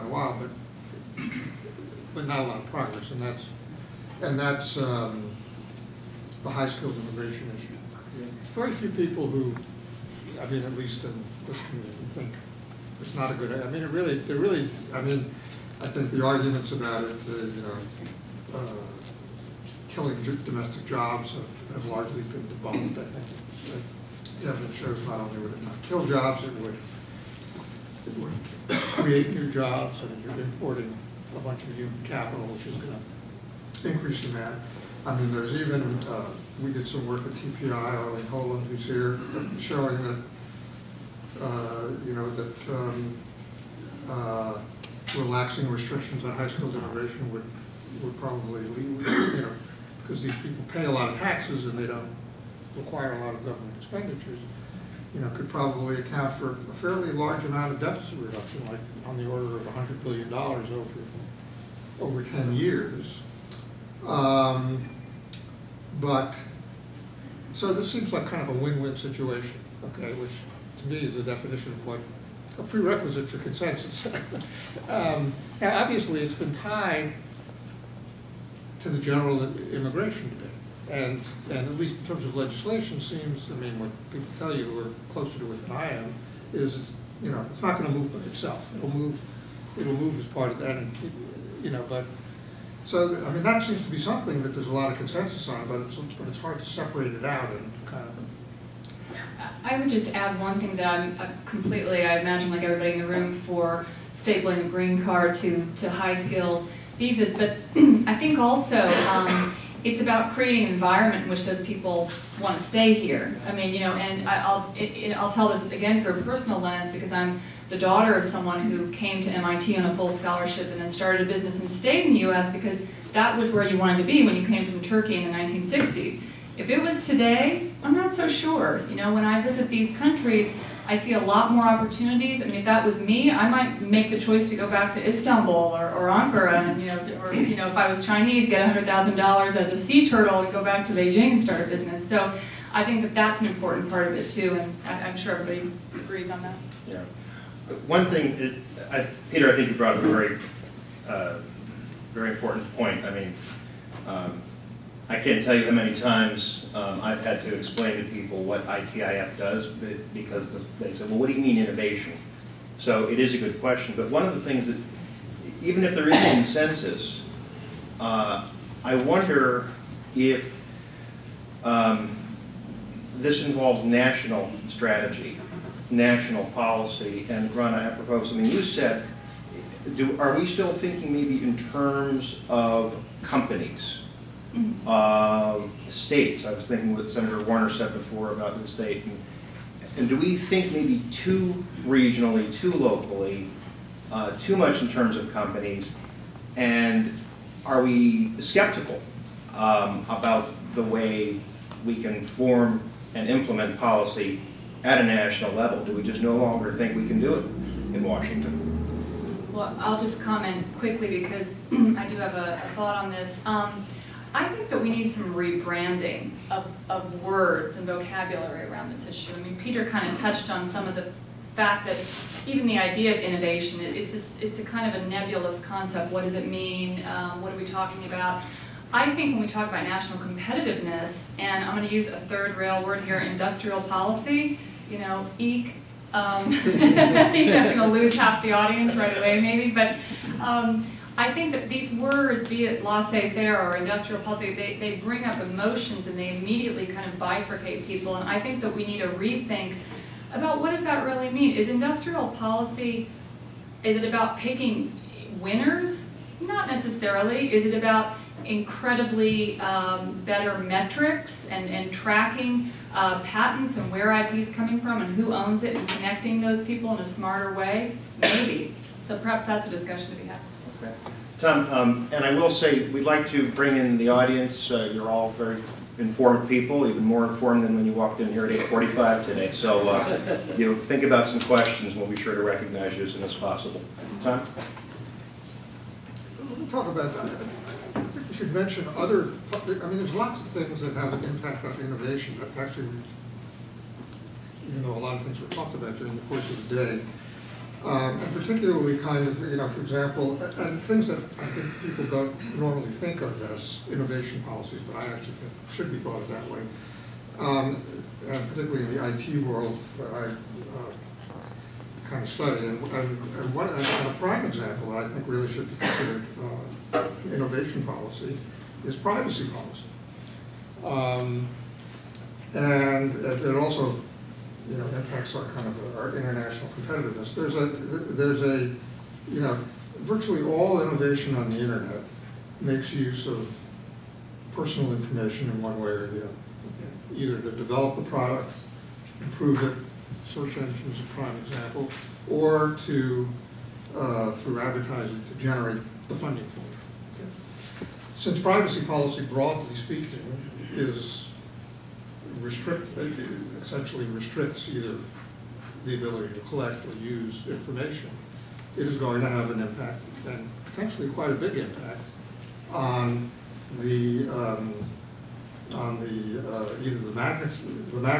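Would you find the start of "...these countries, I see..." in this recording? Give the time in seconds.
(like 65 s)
129 s.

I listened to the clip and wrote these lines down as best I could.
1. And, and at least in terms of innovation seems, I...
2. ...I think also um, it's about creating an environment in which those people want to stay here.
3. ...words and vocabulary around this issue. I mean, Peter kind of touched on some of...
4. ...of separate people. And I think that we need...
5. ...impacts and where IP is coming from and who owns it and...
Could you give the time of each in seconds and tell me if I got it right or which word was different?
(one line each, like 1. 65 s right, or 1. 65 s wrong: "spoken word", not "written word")
1. 80 s wrong: "legislation", not "innovation"
2. 108 s right
3. 217 s right
4. 247 s wrong: "bifurcate", not "separate"
5. 263 s wrong: "patents", not "impacts".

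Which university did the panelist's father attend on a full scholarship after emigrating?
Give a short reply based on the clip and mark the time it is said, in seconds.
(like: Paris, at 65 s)
MIT, at 119 s.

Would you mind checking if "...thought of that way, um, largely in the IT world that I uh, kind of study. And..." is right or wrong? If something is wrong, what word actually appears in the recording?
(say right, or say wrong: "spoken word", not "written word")
wrong: "particularly", not "largely".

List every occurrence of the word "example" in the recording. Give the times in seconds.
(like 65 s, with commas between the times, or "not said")
299 s, 314 s, 341 s.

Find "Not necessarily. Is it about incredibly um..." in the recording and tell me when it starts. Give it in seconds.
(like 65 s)
256 s.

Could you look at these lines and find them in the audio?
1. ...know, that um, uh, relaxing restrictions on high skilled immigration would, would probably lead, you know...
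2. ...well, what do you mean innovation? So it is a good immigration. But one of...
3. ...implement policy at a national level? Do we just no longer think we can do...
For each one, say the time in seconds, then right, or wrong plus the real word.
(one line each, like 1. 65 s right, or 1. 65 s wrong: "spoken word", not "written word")
1. 42 s right
2. 161 s wrong: "question", not "immigration"
3. 203 s right.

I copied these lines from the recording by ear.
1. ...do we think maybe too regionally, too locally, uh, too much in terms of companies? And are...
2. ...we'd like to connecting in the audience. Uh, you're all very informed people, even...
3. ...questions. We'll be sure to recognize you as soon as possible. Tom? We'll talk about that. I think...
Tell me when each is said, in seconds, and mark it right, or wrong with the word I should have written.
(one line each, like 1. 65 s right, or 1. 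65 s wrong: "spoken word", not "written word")
1. 190 s right
2. 272 s wrong: "bring", not "connecting"
3. 281 s right.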